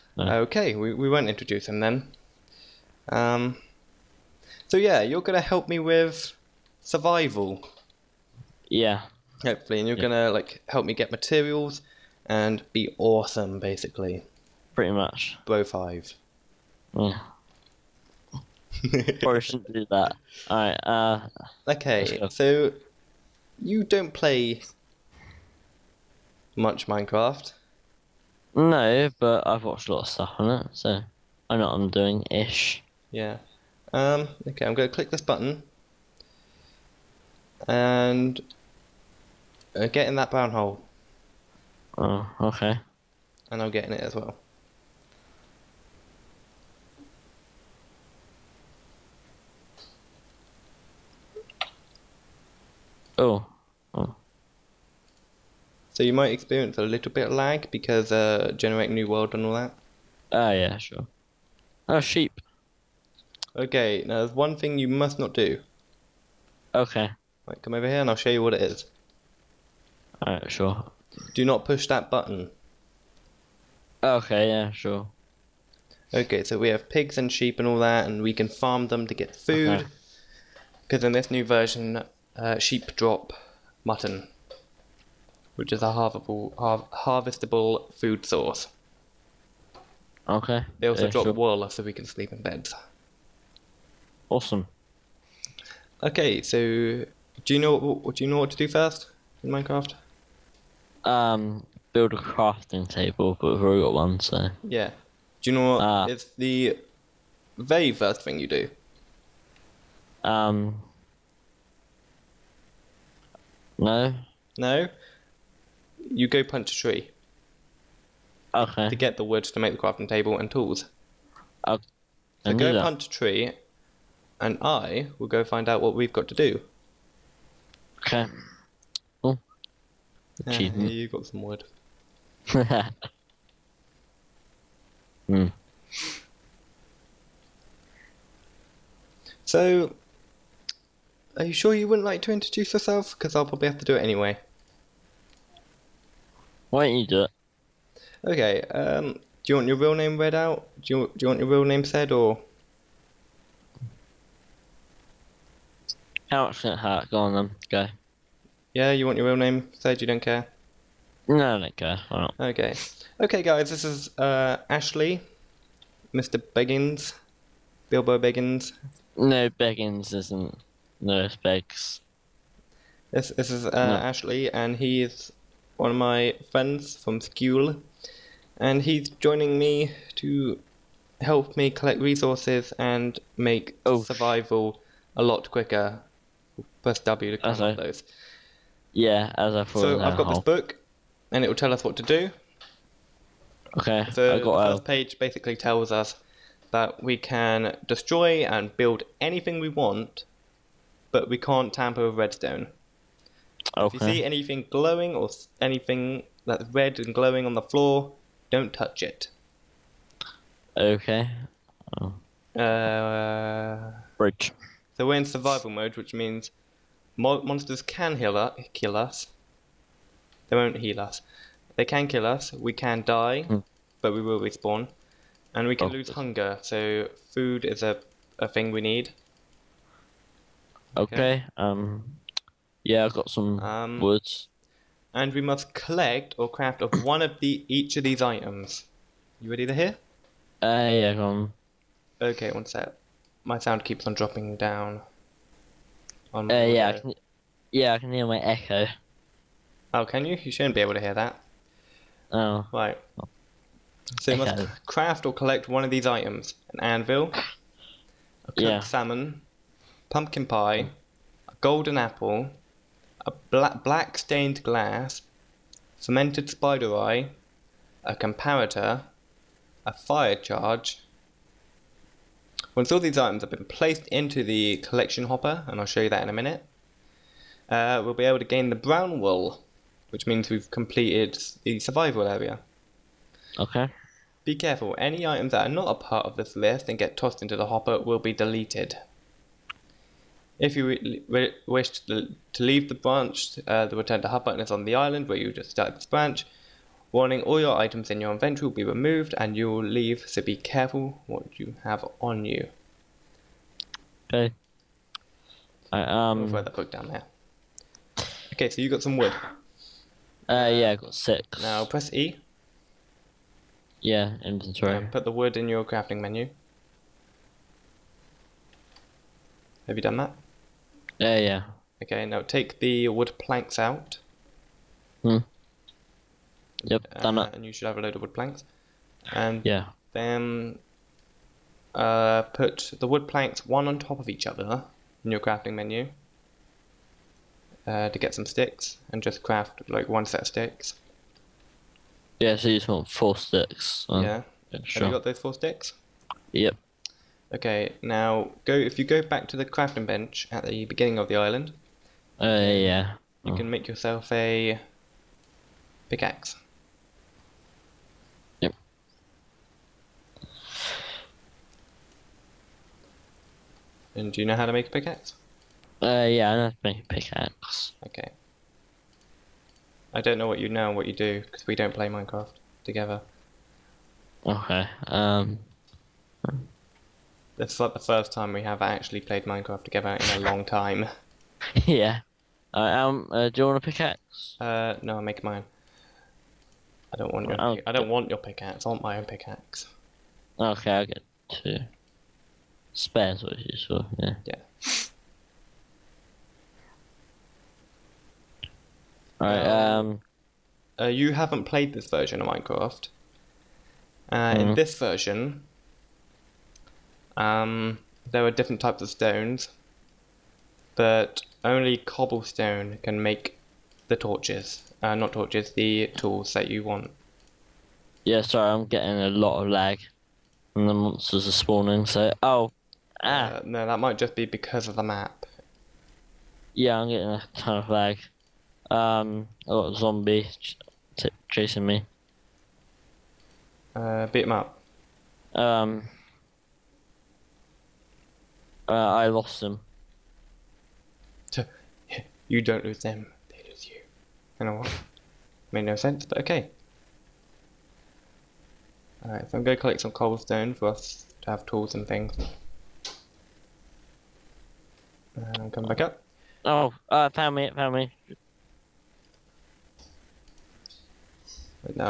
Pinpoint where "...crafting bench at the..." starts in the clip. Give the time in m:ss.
5:49.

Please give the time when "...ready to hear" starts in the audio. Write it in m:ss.
3:59.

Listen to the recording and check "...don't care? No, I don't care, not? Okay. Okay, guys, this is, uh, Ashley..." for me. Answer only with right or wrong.
right.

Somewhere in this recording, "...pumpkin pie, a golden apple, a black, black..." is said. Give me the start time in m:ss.
4:20.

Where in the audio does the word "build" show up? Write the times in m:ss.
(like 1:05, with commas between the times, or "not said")
1:41, 3:18.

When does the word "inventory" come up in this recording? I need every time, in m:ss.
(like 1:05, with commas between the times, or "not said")
4:58, 5:14.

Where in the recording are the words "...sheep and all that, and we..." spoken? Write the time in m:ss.
1:17.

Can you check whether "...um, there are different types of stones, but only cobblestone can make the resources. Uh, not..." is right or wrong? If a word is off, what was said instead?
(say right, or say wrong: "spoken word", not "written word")
wrong: "torches", not "resources".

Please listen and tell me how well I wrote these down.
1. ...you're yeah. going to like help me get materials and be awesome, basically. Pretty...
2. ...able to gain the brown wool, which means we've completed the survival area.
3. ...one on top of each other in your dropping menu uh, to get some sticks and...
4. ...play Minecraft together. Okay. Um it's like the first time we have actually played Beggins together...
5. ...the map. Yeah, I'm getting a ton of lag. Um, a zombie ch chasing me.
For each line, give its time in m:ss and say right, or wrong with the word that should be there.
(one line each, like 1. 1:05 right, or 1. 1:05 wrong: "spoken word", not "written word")
1. 0:09 right
2. 4:38 right
3. 5:33 wrong: "crafting", not "dropping"
4. 6:11 wrong: "Minecraft", not "Beggins"
5. 7:04 right.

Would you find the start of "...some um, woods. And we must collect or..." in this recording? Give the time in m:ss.
3:53.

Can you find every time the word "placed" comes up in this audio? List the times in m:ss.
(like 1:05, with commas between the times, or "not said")
4:33.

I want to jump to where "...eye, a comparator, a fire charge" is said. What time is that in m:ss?
4:26.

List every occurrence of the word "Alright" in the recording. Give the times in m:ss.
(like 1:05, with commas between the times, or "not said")
0:20, 1:10, 6:22, 6:39, 7:29.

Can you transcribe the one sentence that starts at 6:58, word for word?
Yeah, sorry, I'm getting a lot of lag.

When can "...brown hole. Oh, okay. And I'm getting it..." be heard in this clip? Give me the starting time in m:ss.
0:40.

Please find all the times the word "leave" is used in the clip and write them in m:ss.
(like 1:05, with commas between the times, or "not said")
4:52, 4:59.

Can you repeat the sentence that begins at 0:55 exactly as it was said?
So you might experience a little bit of lag because uh, Generate New World and all that.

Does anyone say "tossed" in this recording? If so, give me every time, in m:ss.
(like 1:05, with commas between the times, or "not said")
4:47.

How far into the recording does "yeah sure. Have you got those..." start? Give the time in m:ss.
5:44.